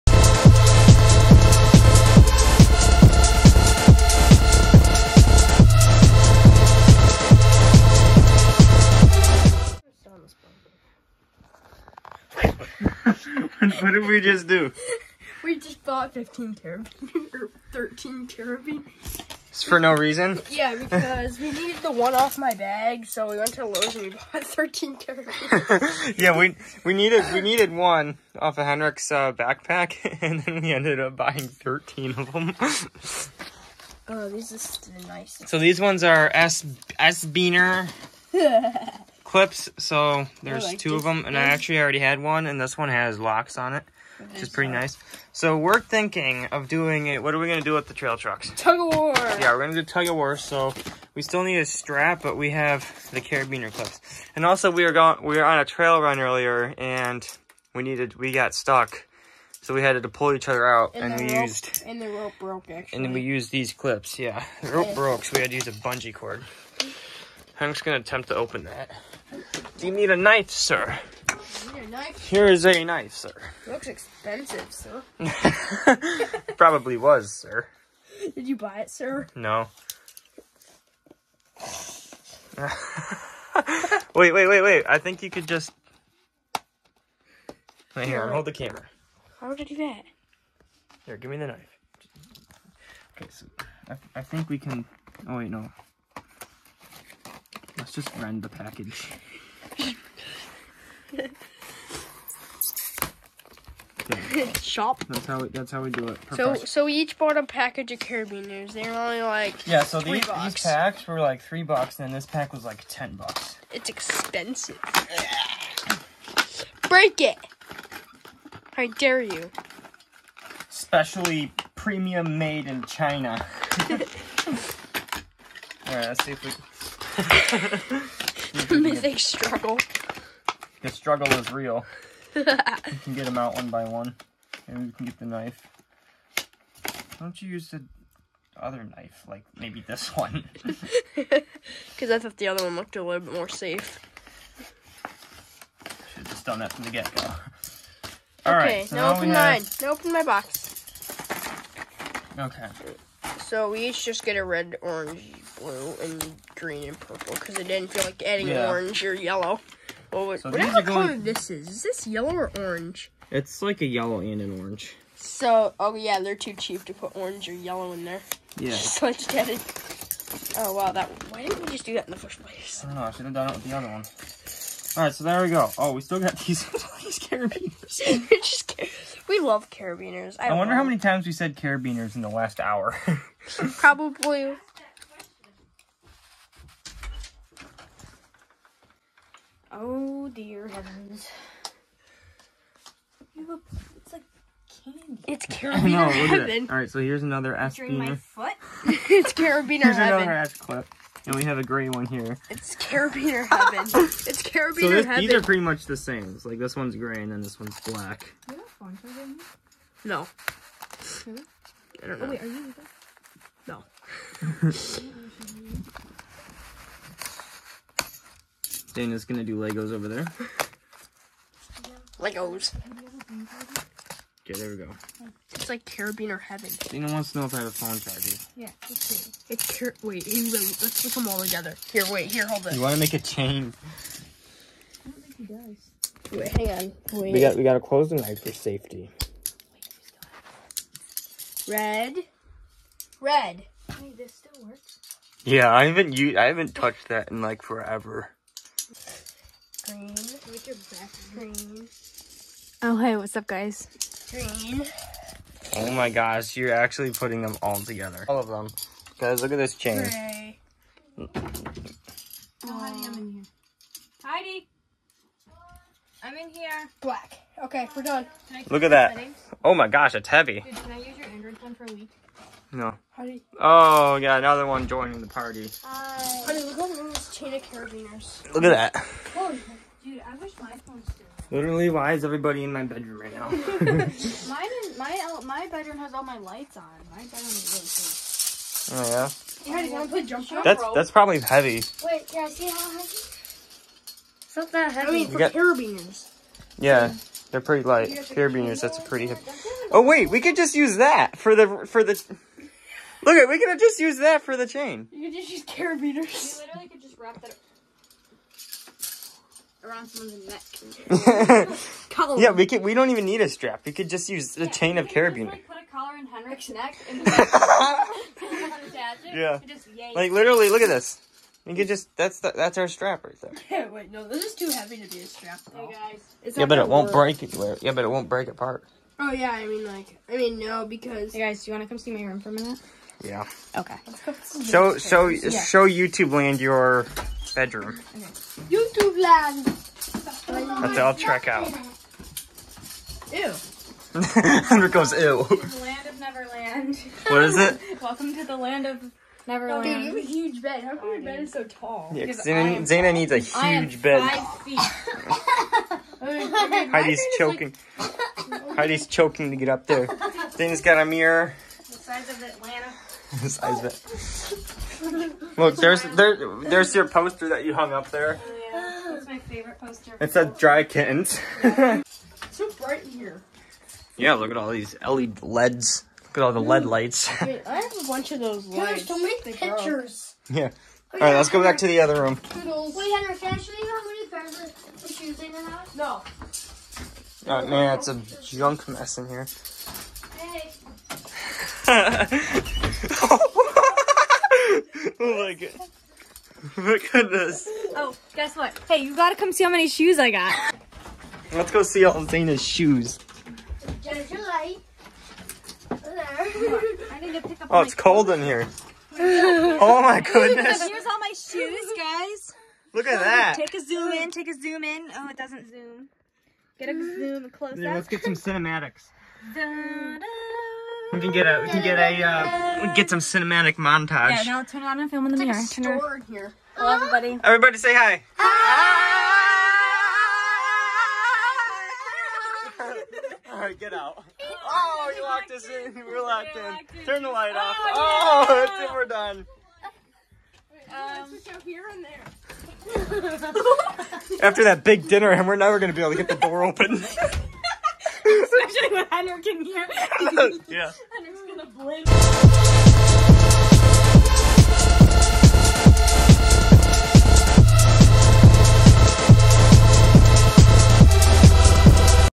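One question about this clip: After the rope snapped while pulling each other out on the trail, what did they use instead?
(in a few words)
A bungee cord.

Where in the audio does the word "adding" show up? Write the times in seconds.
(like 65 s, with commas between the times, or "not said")
158 s.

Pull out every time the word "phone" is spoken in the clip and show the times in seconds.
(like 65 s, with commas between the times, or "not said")
227 s, 271 s, 280 s.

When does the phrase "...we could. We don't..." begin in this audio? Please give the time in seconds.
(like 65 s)
312 s.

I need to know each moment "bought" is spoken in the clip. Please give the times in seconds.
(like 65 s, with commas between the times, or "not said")
15 s, 24 s, 107 s.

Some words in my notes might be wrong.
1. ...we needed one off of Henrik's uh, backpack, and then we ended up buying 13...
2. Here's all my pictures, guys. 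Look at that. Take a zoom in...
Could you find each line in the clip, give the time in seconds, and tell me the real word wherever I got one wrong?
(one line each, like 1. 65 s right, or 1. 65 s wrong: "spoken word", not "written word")
1. 27 s right
2. 410 s wrong: "shoes", not "pictures".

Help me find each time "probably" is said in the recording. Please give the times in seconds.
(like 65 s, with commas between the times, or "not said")
76 s, 183 s, 291 s.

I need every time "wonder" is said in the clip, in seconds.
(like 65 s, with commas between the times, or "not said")
180 s.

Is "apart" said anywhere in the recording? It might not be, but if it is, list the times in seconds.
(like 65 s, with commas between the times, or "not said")
328 s.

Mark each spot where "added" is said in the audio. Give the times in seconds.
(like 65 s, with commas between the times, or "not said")
169 s.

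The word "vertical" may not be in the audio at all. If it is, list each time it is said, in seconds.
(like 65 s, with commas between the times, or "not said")
not said.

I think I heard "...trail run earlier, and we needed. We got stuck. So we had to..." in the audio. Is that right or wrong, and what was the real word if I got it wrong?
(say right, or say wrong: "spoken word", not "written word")
right.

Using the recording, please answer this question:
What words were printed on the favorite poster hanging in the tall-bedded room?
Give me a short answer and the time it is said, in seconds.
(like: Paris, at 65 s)
Dry kittens, at 370 s.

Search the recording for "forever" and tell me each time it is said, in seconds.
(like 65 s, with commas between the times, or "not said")
247 s.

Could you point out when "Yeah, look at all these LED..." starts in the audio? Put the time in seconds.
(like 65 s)
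374 s.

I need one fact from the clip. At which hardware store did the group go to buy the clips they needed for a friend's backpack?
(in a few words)
Lowe's.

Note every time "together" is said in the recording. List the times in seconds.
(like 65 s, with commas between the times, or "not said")
231 s, 257 s.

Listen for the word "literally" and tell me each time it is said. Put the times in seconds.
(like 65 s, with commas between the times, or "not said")
281 s, 306 s, 320 s.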